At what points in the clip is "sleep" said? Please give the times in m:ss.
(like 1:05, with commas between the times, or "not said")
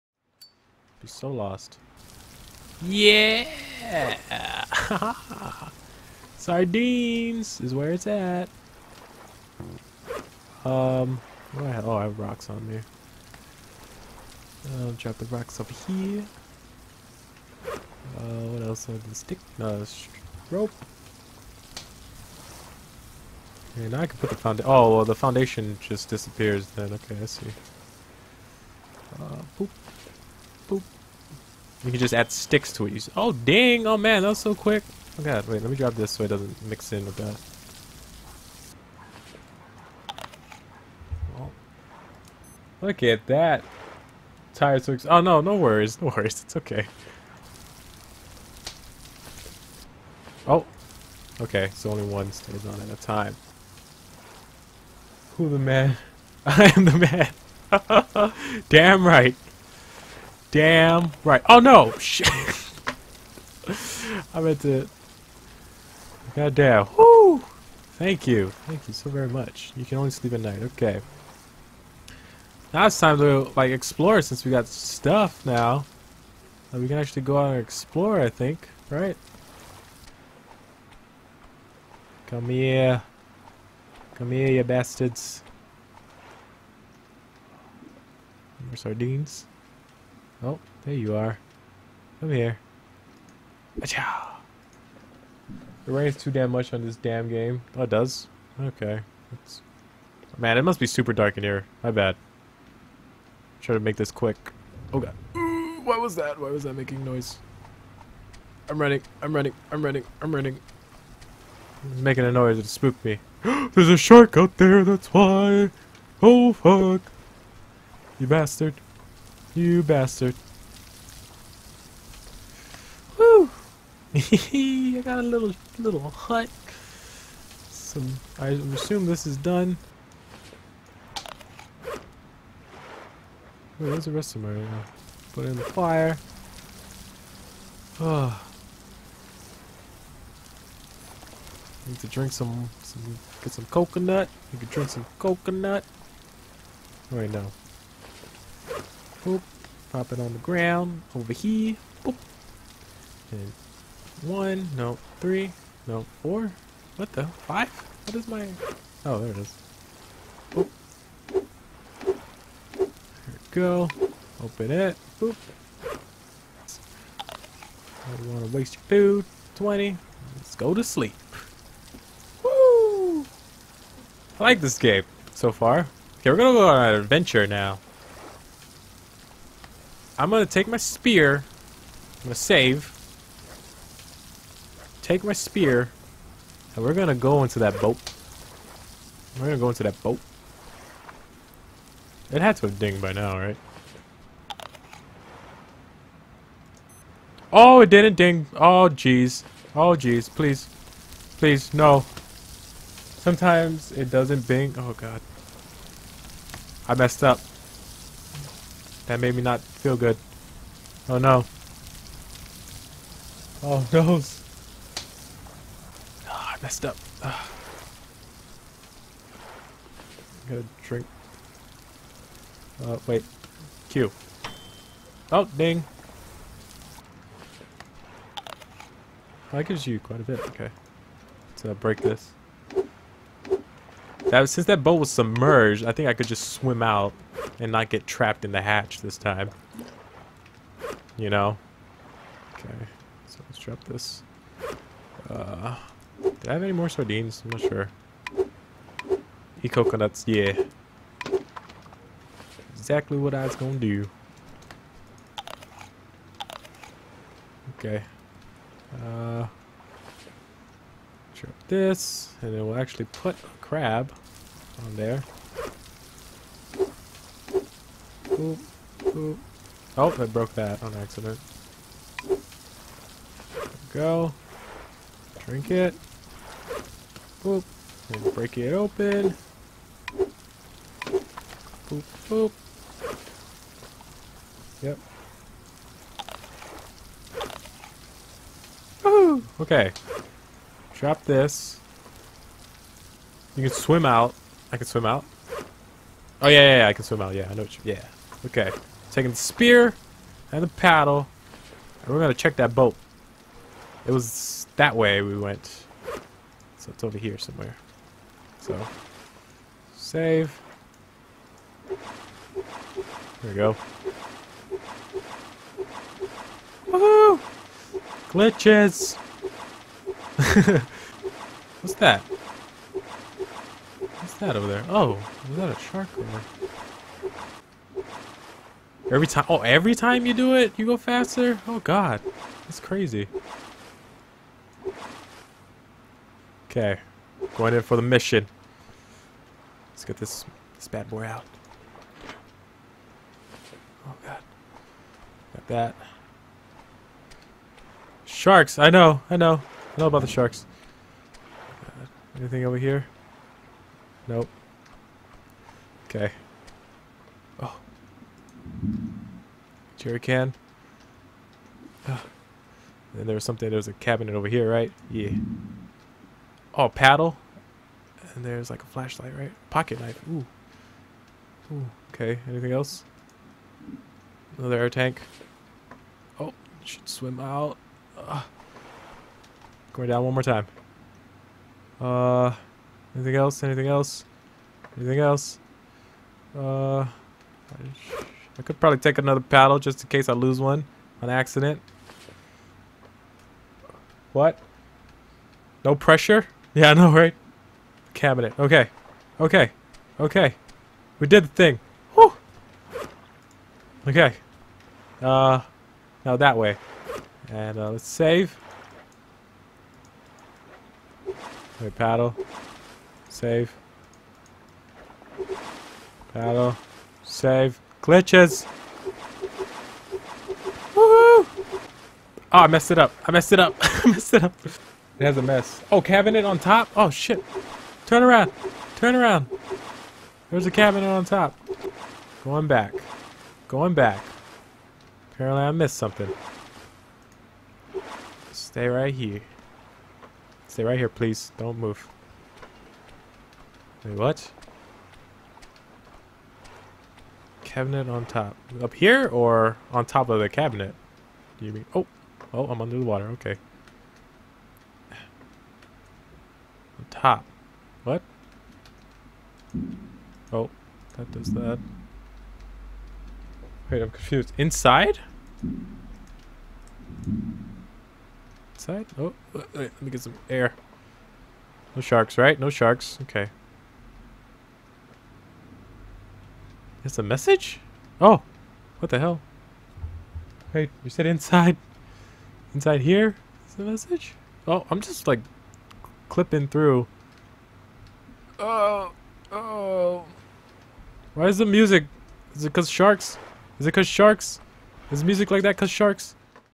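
1:10, 2:50.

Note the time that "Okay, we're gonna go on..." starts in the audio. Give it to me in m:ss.
2:56.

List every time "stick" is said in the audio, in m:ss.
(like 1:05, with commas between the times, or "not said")
0:19, 0:32.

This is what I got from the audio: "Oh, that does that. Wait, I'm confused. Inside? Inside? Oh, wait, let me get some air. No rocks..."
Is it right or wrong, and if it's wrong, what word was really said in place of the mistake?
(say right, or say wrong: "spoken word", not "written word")
wrong: "sharks", not "rocks".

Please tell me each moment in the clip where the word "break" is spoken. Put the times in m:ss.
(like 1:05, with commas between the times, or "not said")
3:51, 4:38.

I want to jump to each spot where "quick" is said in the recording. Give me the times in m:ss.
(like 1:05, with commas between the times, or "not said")
0:34, 1:44.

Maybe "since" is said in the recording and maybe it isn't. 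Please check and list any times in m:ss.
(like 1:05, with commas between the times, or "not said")
1:14, 3:54.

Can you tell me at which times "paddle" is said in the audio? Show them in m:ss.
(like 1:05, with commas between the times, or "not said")
5:00, 6:06, 6:29, 6:51, 6:56.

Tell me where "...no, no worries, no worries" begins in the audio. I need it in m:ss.
0:45.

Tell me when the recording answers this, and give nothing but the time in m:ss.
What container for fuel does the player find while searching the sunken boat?
6:00.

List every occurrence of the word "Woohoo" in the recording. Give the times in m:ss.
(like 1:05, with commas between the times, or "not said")
4:49, 5:16, 7:00.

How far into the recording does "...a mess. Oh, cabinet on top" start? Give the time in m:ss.
7:05.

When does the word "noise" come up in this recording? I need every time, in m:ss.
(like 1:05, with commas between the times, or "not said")
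1:47, 1:52.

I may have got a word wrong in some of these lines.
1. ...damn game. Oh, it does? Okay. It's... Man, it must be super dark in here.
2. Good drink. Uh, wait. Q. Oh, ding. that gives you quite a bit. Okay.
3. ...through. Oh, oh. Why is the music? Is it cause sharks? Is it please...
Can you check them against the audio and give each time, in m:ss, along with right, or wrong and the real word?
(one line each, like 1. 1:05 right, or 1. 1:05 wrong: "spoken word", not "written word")
1. 1:36 right
2. 3:40 right
3. 8:06 wrong: "cause", not "please".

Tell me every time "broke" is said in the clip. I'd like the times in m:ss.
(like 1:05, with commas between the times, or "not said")
4:30.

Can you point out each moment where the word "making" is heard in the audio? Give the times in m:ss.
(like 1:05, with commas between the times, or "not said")
1:46, 1:52.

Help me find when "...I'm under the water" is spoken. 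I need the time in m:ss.
7:32.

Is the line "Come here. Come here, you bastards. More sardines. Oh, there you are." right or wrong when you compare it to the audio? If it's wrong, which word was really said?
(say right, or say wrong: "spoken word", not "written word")
right.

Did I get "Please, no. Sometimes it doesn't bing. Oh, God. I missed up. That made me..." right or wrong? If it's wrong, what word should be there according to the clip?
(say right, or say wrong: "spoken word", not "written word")
wrong: "messed", not "missed".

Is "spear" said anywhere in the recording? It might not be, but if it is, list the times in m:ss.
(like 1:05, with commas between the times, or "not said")
3:00, 3:05, 4:59.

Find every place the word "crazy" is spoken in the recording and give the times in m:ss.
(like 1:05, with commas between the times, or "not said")
5:32.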